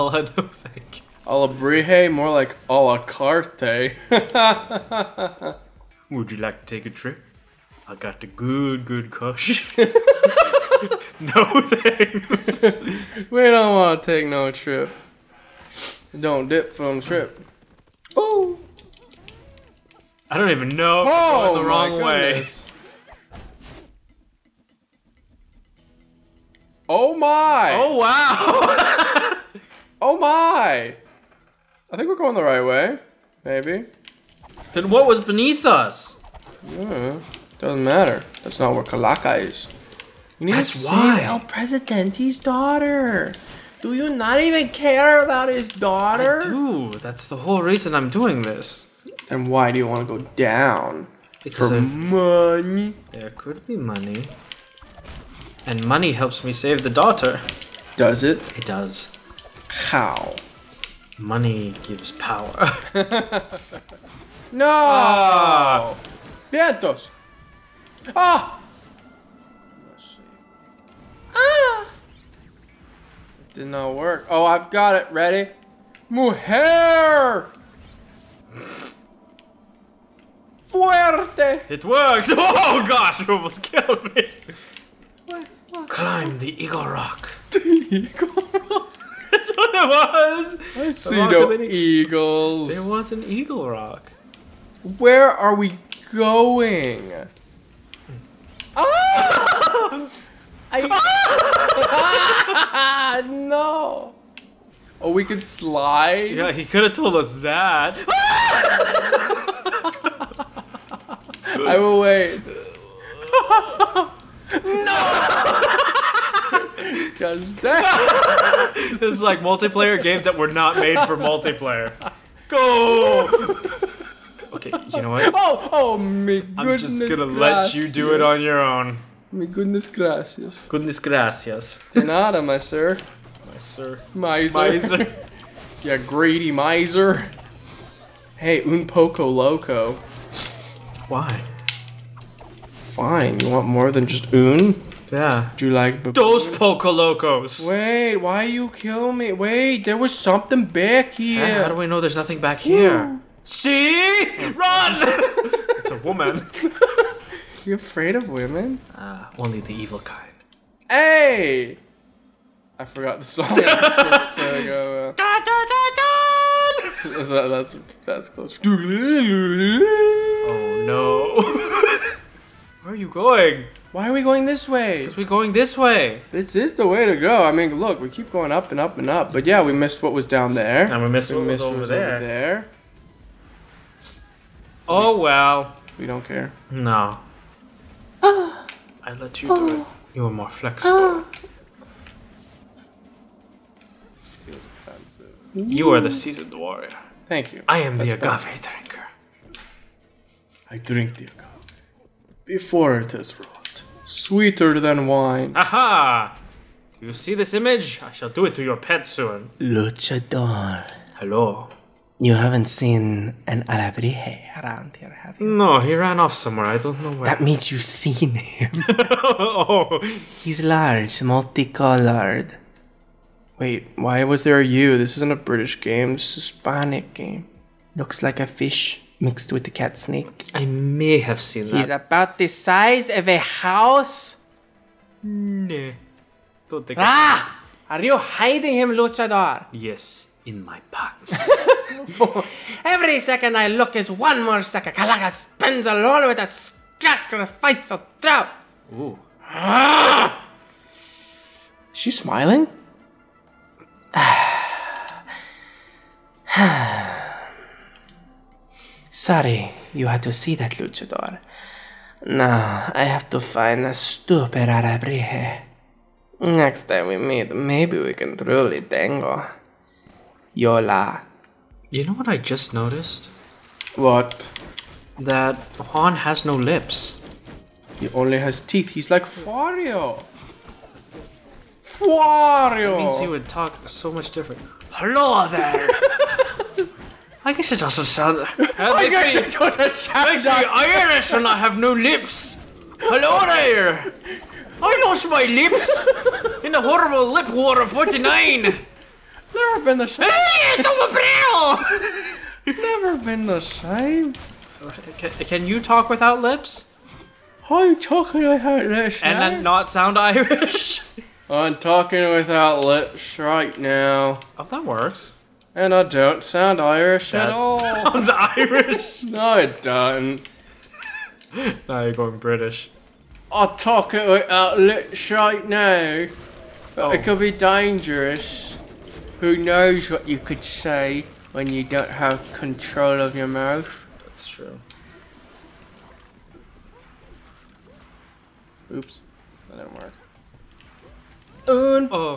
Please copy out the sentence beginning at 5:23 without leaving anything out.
I talk it without lips right now.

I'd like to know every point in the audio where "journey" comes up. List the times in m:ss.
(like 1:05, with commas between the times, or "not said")
not said.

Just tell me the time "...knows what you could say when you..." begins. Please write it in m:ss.
5:29.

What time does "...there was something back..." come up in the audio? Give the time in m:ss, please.
2:29.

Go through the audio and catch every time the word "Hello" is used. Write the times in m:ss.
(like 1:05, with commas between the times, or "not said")
3:31, 4:44, 4:52.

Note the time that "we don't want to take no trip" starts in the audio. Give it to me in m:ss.
0:13.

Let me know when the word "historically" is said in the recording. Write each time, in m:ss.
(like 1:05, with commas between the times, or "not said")
not said.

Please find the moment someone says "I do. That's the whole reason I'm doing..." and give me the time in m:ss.
0:46.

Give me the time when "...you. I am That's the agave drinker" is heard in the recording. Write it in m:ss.
3:17.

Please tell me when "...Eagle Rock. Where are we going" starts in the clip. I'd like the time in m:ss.
1:33.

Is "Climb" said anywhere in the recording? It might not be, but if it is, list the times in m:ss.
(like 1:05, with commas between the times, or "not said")
1:25.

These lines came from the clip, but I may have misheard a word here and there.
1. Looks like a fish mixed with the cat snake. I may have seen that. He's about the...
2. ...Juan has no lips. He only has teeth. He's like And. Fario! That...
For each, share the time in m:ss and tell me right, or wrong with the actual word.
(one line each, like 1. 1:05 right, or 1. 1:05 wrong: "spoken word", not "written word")
1. 3:47 right
2. 4:35 wrong: "Fario", not "And".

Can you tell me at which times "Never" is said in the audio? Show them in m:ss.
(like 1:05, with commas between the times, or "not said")
4:58, 5:02.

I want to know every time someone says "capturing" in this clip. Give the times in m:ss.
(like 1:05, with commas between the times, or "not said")
not said.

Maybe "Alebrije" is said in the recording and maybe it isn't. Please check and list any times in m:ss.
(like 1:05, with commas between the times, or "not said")
3:33, 4:24.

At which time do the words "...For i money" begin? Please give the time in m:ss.
0:51.